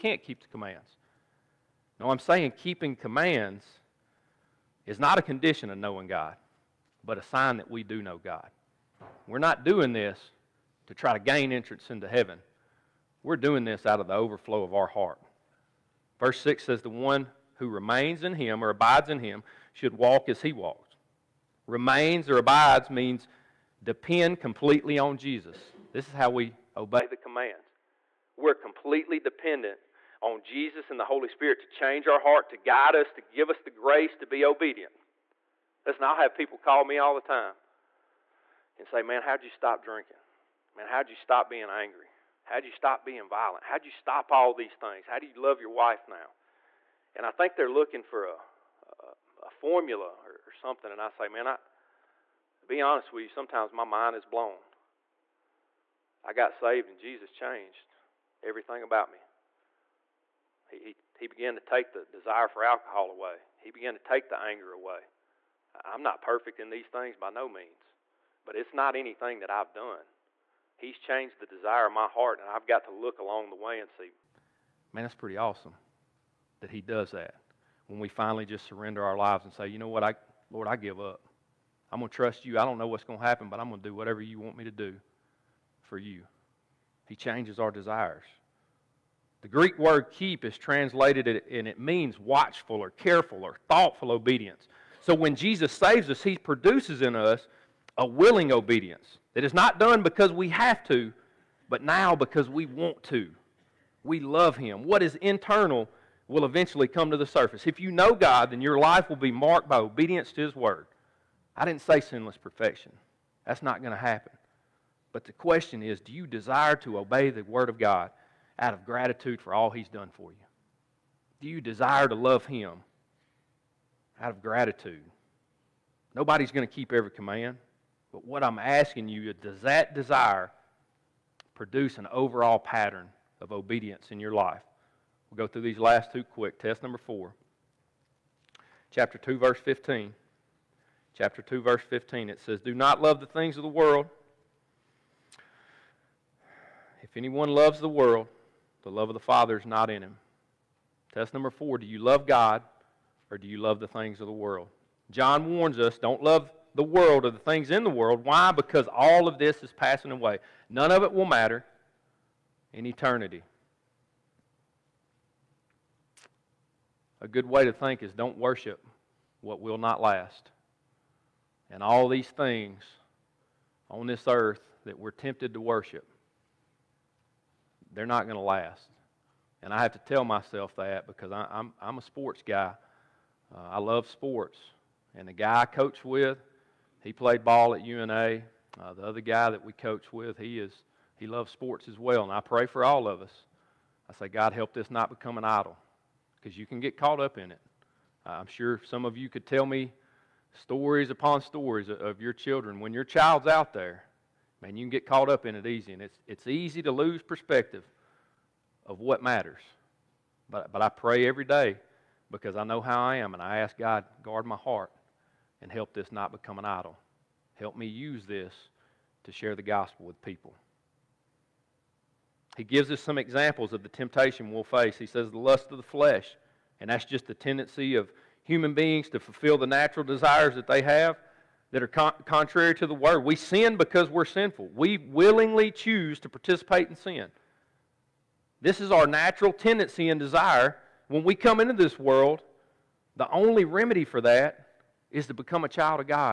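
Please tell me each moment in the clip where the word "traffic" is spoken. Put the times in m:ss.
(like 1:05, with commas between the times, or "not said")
not said.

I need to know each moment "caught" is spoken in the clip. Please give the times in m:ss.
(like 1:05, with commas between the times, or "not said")
3:16, 3:25.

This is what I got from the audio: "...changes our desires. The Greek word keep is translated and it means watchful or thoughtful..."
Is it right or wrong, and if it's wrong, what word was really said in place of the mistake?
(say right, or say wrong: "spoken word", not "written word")
wrong: "careful", not "thoughtful".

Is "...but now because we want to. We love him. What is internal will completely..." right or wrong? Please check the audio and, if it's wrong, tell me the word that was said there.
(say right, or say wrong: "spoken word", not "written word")
wrong: "eventually", not "completely".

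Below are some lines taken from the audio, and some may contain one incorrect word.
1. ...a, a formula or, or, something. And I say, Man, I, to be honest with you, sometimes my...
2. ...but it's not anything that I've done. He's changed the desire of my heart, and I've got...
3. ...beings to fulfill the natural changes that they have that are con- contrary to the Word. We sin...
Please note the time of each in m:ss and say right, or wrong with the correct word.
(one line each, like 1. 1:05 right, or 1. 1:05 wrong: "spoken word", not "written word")
1. 0:49 right
2. 1:08 right
3. 3:48 wrong: "desires", not "changes".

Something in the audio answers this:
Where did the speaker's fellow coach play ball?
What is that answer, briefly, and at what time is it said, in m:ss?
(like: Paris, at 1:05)
UNA, at 3:07.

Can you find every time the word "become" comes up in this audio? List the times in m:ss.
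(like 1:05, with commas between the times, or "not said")
3:15, 3:36, 4:05.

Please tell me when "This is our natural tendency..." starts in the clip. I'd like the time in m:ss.
3:58.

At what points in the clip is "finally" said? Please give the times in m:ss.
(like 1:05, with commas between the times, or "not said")
1:18.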